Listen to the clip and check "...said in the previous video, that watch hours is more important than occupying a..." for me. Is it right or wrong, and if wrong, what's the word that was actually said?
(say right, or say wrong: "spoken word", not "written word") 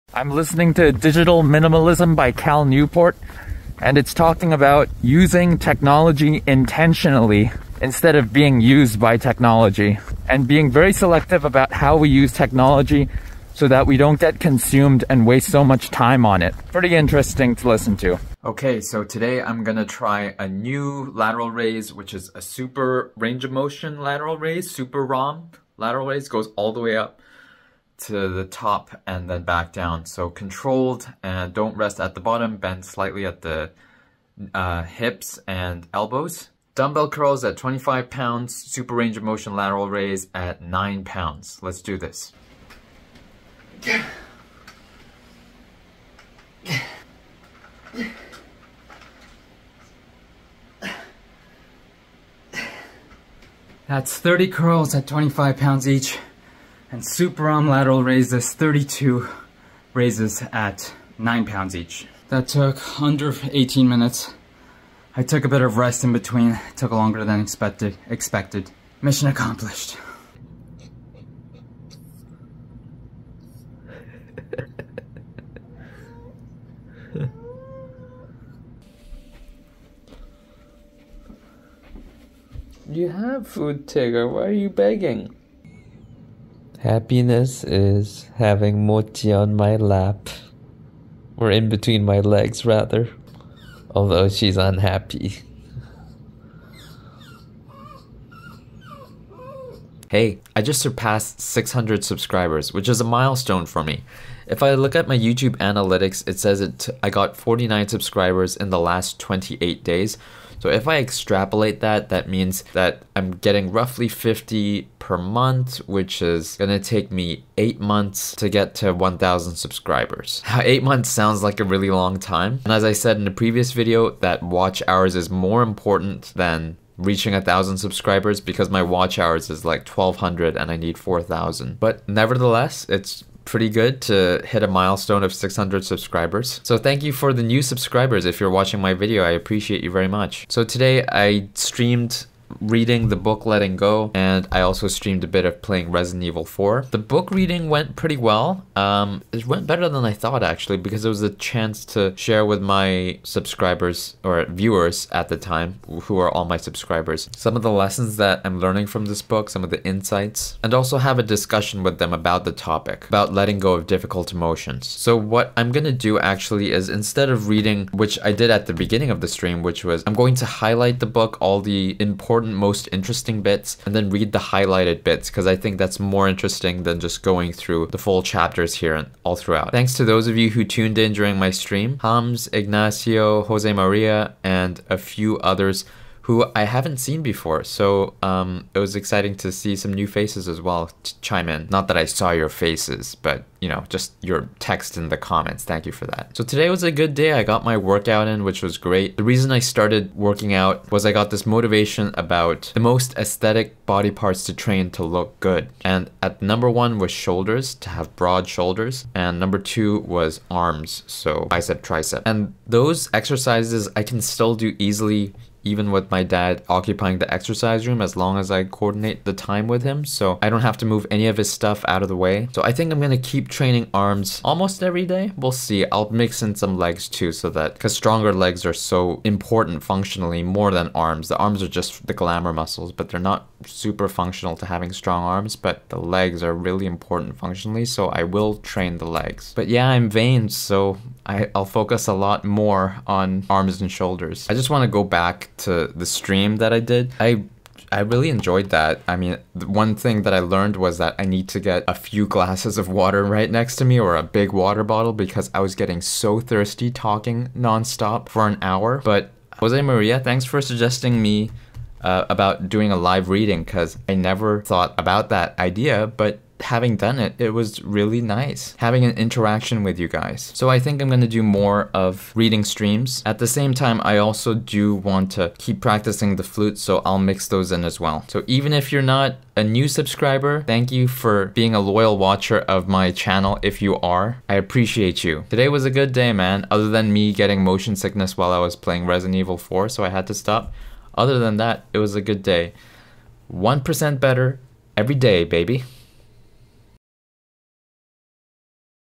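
wrong: "reaching", not "occupying".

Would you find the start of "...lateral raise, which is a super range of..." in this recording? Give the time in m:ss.
0:21.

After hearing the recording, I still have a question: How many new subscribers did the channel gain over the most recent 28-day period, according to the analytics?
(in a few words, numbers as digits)
49.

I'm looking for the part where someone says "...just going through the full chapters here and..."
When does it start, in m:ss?
2:56.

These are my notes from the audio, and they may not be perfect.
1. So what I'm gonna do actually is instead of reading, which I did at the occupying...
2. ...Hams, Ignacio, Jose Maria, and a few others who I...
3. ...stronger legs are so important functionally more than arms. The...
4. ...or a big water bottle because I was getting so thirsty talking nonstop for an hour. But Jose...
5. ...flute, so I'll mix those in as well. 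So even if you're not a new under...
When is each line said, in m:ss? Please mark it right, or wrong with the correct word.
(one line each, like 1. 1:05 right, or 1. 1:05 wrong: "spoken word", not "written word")
1. 2:44 wrong: "beginning", not "occupying"
2. 3:02 right
3. 3:47 right
4. 4:13 right
5. 4:36 wrong: "subscriber", not "under".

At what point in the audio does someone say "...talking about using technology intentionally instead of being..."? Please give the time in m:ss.
0:04.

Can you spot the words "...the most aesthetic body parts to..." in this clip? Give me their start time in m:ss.
3:22.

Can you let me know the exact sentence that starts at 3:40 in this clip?
So I don't have to move any of his stuff out of the way.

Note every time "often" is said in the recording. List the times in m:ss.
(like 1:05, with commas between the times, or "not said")
not said.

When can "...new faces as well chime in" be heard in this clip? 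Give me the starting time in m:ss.
3:09.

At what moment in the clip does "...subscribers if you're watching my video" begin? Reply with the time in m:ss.
2:17.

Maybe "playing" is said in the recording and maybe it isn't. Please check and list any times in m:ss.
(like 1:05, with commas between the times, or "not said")
2:25, 4:48.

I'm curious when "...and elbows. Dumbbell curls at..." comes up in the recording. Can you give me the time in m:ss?
0:35.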